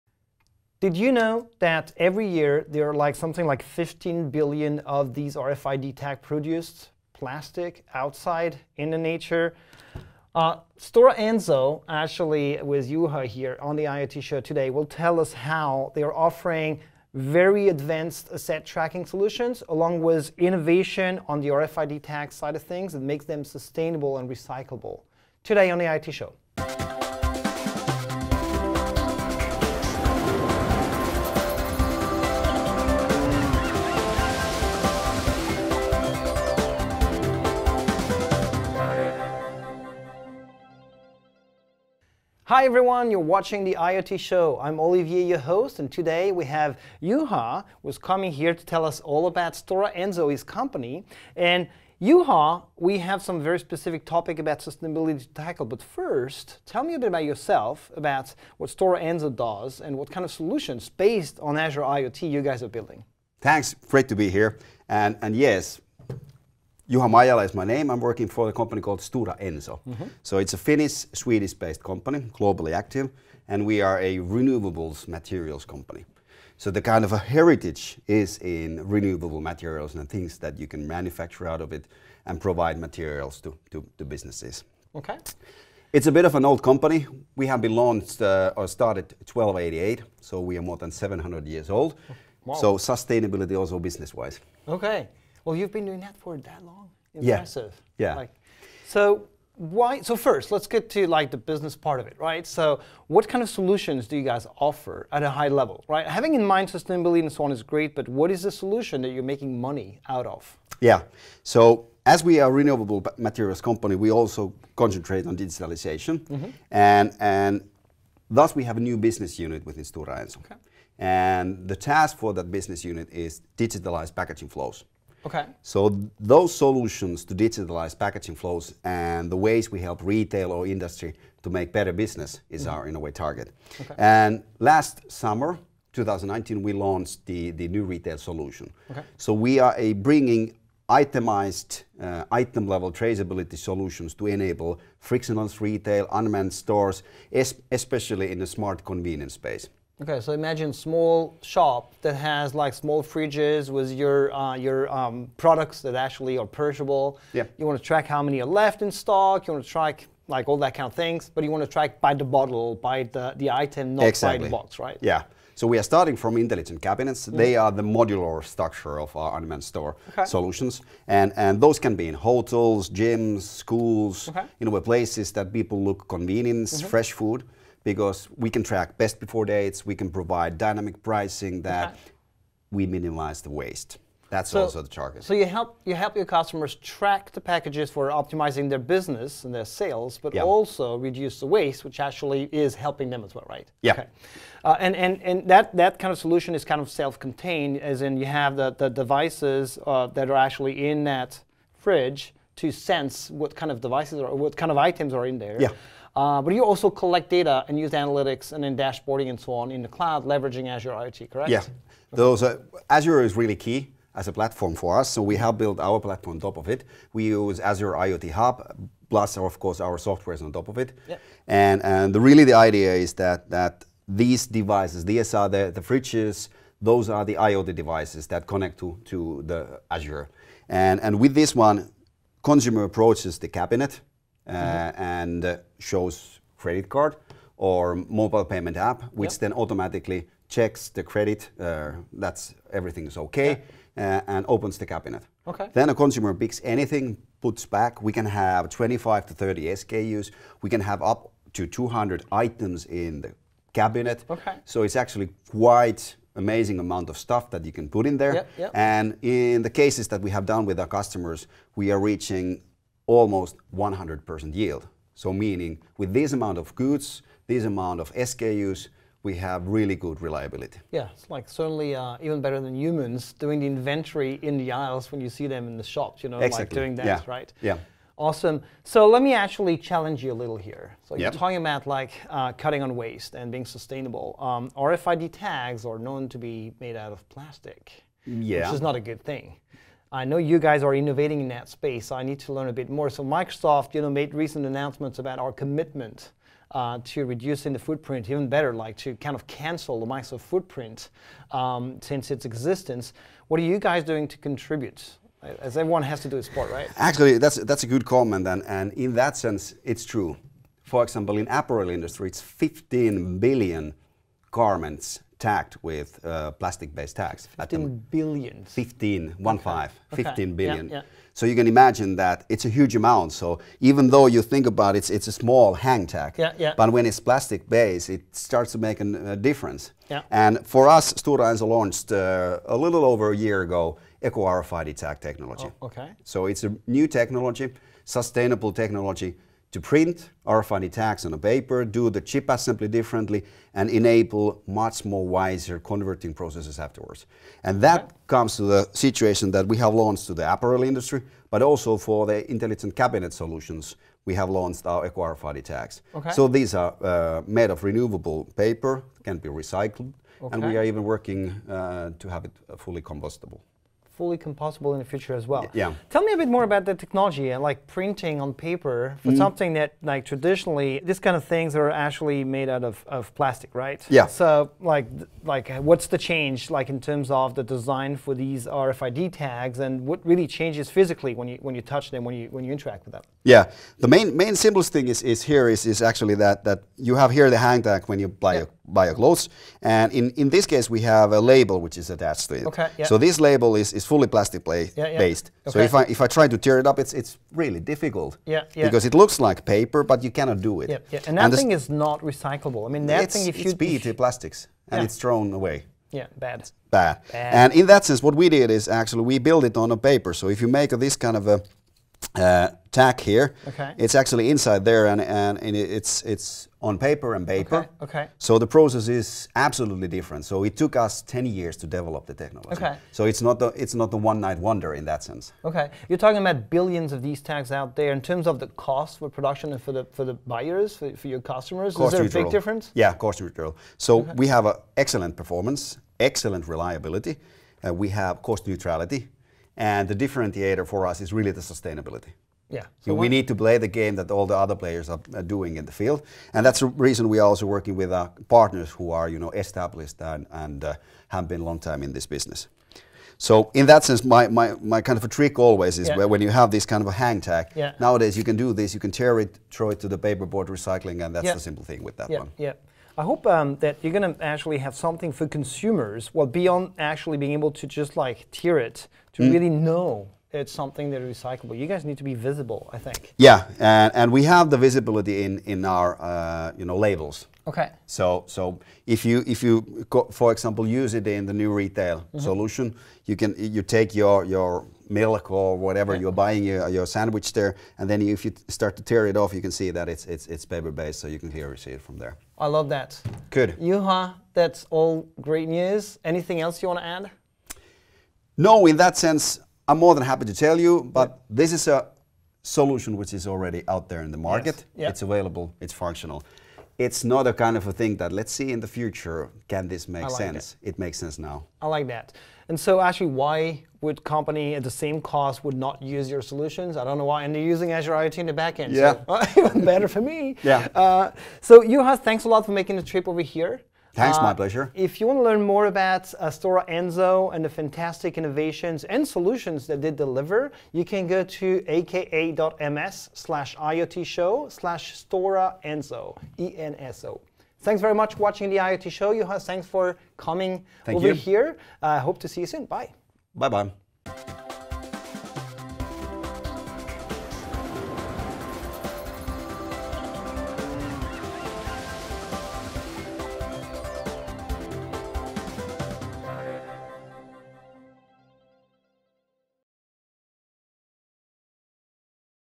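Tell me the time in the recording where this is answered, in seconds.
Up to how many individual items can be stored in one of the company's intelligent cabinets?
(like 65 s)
251 s.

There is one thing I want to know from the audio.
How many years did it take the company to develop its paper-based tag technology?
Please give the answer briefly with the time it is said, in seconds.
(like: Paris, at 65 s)
ten years, at 421 s.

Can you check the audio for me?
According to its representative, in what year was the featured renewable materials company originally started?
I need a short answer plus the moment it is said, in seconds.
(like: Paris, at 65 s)
1288, at 89 s.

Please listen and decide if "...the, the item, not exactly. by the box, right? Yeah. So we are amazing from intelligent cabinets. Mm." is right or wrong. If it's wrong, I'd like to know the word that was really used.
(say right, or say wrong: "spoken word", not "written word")
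wrong: "starting", not "amazing".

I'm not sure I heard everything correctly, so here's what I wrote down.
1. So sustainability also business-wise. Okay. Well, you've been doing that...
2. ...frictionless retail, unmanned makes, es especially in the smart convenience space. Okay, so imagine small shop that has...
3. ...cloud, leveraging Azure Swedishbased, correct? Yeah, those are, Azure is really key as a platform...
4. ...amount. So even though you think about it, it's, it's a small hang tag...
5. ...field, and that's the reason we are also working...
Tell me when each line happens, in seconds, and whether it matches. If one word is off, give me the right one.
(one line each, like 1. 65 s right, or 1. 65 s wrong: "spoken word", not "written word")
1. 92 s right
2. 144 s wrong: "stores", not "makes"
3. 209 s wrong: "IoT", not "Swedishbased"
4. 322 s right
5. 445 s right.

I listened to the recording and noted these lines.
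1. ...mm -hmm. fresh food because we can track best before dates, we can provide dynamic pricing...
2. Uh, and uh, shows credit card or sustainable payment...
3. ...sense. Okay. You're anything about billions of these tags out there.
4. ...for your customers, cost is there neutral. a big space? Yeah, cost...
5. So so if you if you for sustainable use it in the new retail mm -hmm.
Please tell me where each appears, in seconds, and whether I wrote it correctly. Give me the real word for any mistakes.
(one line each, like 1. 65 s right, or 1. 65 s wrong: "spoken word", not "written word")
1. 176 s right
2. 234 s wrong: "mobile", not "sustainable"
3. 425 s wrong: "talking", not "anything"
4. 431 s wrong: "difference", not "space"
5. 478 s wrong: "example", not "sustainable".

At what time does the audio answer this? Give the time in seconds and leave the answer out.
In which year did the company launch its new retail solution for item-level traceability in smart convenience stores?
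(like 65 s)
135 s.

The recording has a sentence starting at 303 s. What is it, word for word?
What are you guys doing to contribute?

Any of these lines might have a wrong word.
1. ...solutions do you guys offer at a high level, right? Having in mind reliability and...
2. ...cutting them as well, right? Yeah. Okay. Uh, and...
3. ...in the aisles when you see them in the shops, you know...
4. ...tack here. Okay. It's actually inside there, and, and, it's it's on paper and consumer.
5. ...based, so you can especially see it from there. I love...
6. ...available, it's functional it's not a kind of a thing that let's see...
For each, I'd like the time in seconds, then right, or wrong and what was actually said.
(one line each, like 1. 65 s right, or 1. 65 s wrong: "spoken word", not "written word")
1. 103 s wrong: "sustainability", not "reliability"
2. 192 s wrong: "helping", not "cutting"
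3. 274 s right
4. 412 s wrong: "paper", not "consumer"
5. 490 s wrong: "clearly", not "especially"
6. 505 s right.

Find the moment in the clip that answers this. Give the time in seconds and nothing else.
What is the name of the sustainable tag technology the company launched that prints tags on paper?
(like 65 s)
334 s.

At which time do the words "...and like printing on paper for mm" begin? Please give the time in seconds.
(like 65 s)
367 s.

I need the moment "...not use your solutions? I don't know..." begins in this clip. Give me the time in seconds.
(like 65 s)
515 s.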